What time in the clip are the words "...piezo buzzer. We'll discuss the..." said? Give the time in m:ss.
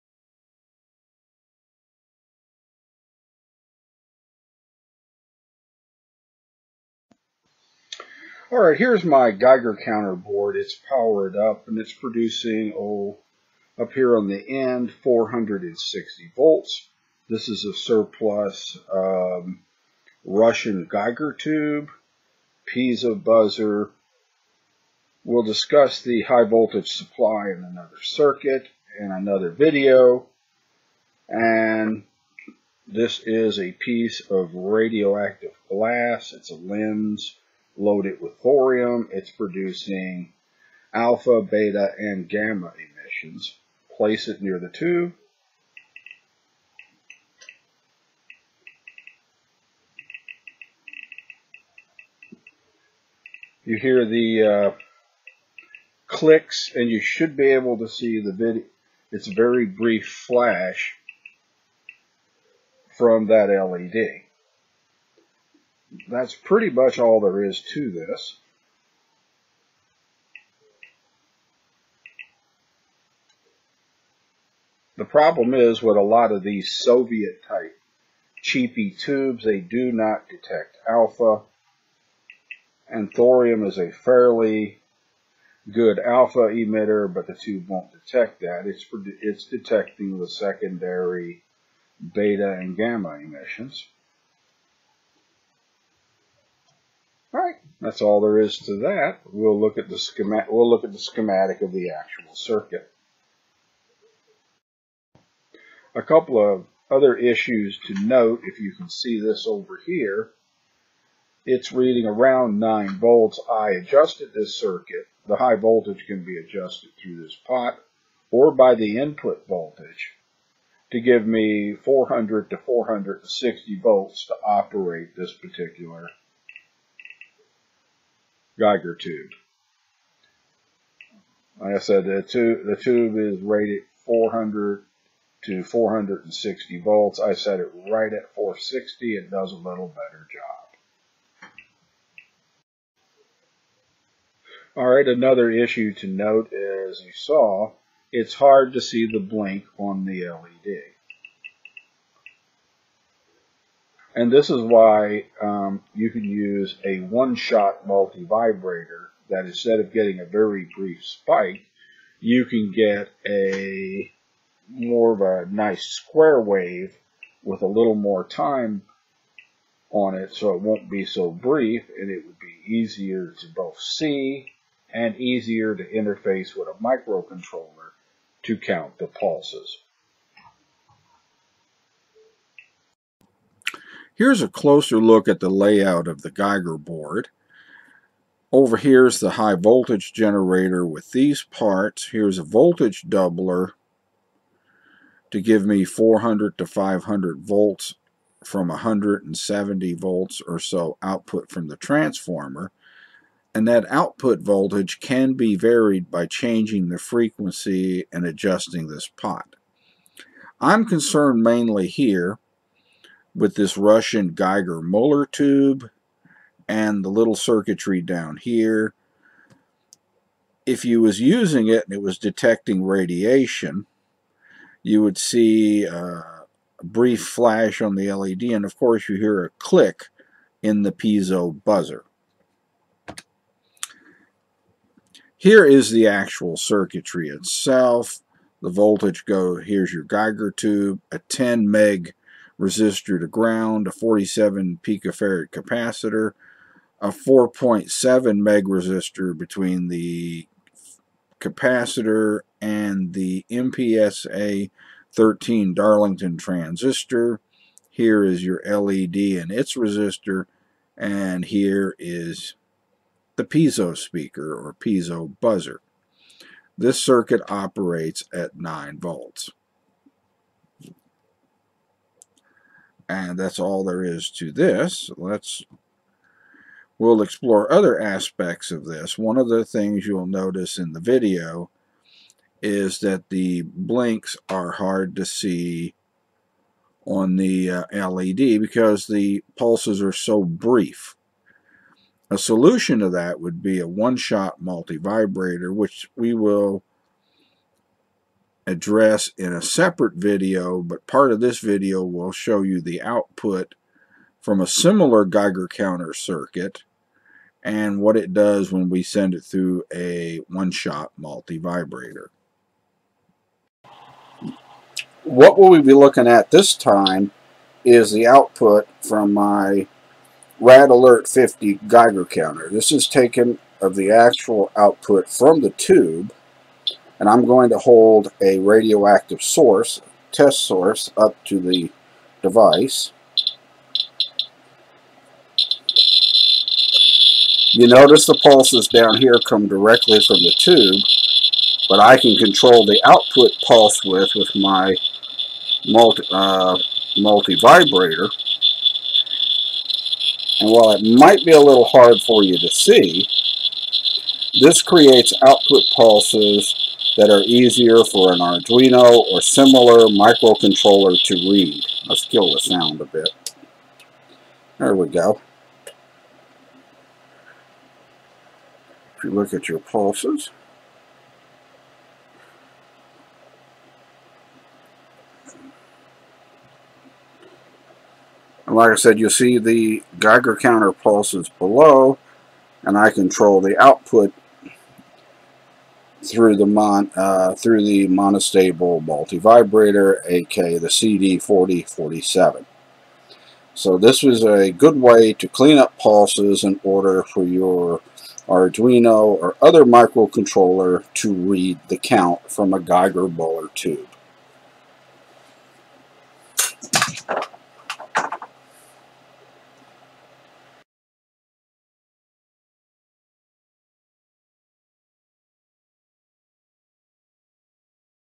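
0:22.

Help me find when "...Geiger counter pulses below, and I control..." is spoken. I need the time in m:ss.
6:20.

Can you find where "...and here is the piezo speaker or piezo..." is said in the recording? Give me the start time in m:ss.
4:20.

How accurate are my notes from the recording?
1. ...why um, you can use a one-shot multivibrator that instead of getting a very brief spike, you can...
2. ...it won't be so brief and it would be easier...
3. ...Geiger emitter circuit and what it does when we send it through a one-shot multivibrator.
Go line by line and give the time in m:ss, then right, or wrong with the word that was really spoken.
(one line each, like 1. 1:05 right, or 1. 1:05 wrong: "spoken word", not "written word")
1. 2:34 right
2. 2:50 right
3. 5:05 wrong: "counter", not "emitter".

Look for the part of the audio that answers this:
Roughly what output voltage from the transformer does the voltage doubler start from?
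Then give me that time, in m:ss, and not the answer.
3:18.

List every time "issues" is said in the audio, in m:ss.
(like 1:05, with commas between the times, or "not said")
1:47, 2:25.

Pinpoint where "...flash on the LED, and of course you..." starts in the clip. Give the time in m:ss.
3:47.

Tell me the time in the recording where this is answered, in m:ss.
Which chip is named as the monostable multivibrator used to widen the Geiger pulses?
6:30.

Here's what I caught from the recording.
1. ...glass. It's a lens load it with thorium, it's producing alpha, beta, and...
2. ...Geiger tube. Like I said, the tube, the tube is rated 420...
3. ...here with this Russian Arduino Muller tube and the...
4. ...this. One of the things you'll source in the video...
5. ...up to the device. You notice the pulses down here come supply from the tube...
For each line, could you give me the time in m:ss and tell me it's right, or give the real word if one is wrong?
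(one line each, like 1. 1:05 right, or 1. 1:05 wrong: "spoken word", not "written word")
1. 0:35 right
2. 2:08 wrong: "400", not "420"
3. 3:31 wrong: "Geiger", not "Arduino"
4. 4:38 wrong: "notice", not "source"
5. 5:31 wrong: "directly", not "supply".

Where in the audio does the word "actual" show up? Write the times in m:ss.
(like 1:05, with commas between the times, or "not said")
1:41, 3:56, 5:24.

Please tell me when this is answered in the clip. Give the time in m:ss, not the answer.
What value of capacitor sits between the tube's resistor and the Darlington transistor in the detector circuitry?
4:03.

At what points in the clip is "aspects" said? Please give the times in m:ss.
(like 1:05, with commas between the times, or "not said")
4:37.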